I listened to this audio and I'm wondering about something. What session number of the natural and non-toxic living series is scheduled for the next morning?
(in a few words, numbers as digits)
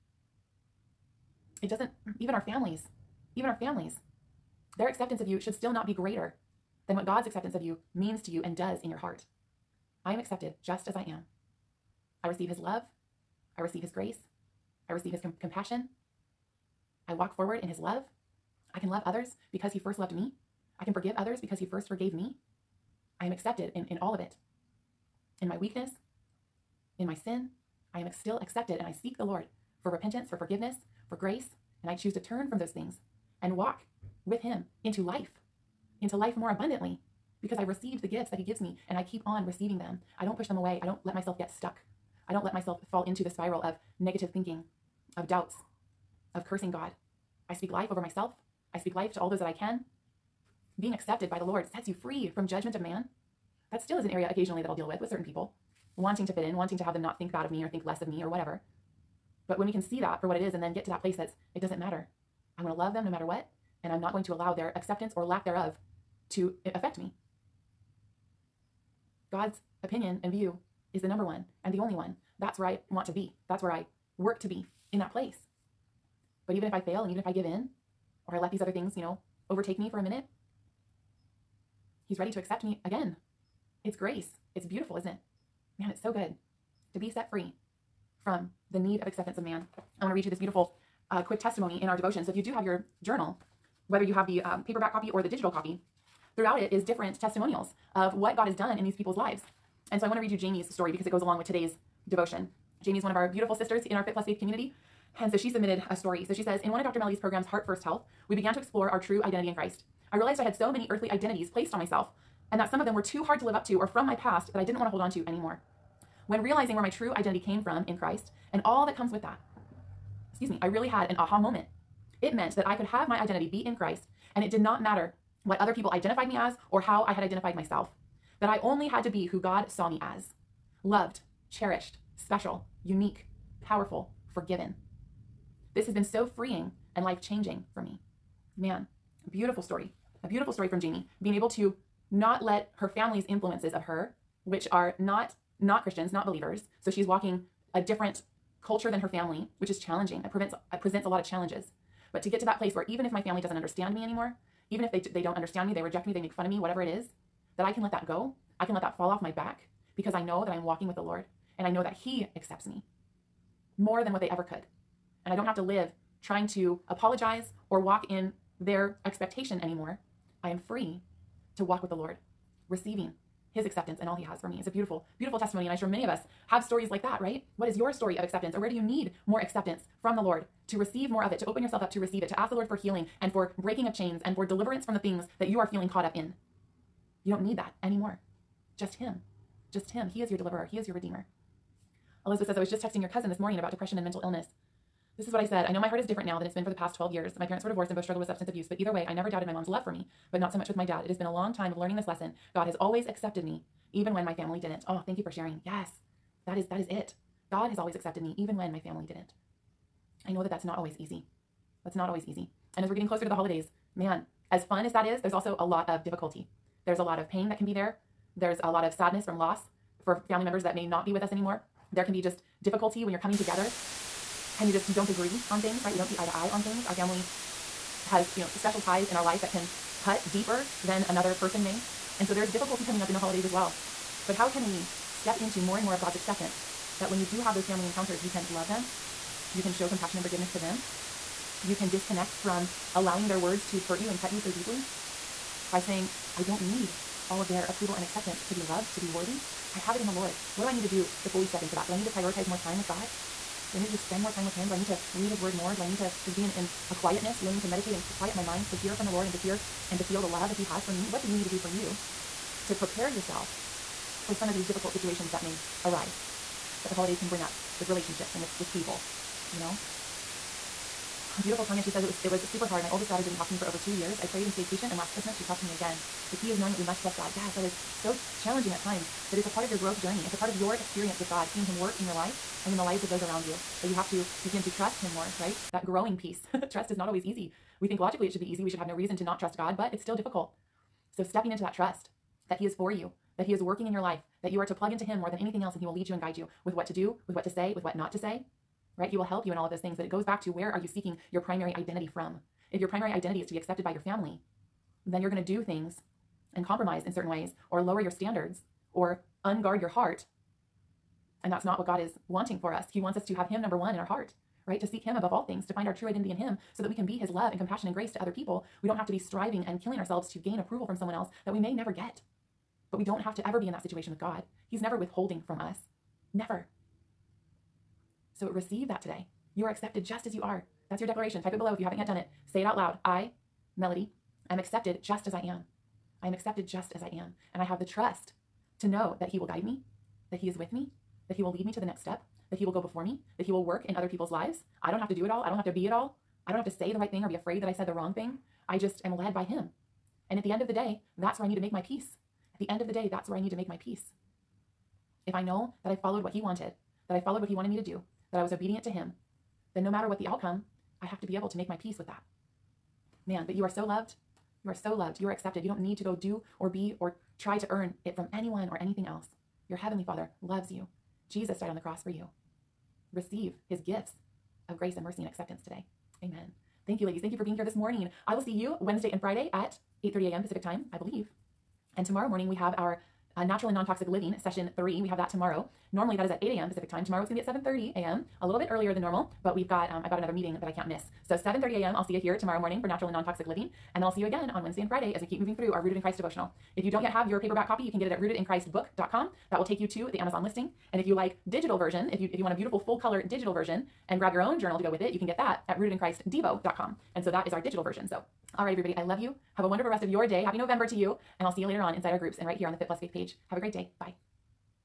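three.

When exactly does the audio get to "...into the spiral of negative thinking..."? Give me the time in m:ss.
0:43.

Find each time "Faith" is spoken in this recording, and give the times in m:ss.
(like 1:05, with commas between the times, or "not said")
1:44, 6:52.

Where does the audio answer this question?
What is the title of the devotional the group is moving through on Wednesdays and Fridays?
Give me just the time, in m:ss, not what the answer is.
6:35.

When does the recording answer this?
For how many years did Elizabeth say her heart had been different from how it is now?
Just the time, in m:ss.
3:16.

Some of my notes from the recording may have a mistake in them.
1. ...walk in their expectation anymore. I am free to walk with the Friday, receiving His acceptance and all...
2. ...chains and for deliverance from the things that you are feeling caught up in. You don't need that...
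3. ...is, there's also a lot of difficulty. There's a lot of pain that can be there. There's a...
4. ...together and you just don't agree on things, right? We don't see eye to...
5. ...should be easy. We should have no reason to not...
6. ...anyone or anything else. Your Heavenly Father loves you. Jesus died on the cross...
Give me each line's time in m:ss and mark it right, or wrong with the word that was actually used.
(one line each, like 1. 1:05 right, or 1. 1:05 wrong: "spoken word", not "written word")
1. 2:47 wrong: "Lord", not "Friday"
2. 3:03 right
3. 3:35 right
4. 3:43 right
5. 4:48 right
6. 6:08 right.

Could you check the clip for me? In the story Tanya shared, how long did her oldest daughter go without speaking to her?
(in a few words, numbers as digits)
over 2 years.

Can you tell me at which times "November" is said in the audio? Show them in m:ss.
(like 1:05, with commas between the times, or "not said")
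6:50.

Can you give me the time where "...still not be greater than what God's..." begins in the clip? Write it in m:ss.
0:05.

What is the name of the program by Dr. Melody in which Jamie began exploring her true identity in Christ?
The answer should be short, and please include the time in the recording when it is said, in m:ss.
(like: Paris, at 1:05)
Heart First Health, at 1:47.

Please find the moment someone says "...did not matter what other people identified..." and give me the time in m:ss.
2:04.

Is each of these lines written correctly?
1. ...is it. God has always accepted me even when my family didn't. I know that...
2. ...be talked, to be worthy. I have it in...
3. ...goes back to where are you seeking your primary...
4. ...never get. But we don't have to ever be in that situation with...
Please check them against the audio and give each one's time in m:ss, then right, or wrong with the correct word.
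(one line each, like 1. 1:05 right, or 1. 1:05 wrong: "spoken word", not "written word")
1. 3:26 right
2. 4:08 wrong: "loved", not "talked"
3. 5:00 right
4. 5:21 right.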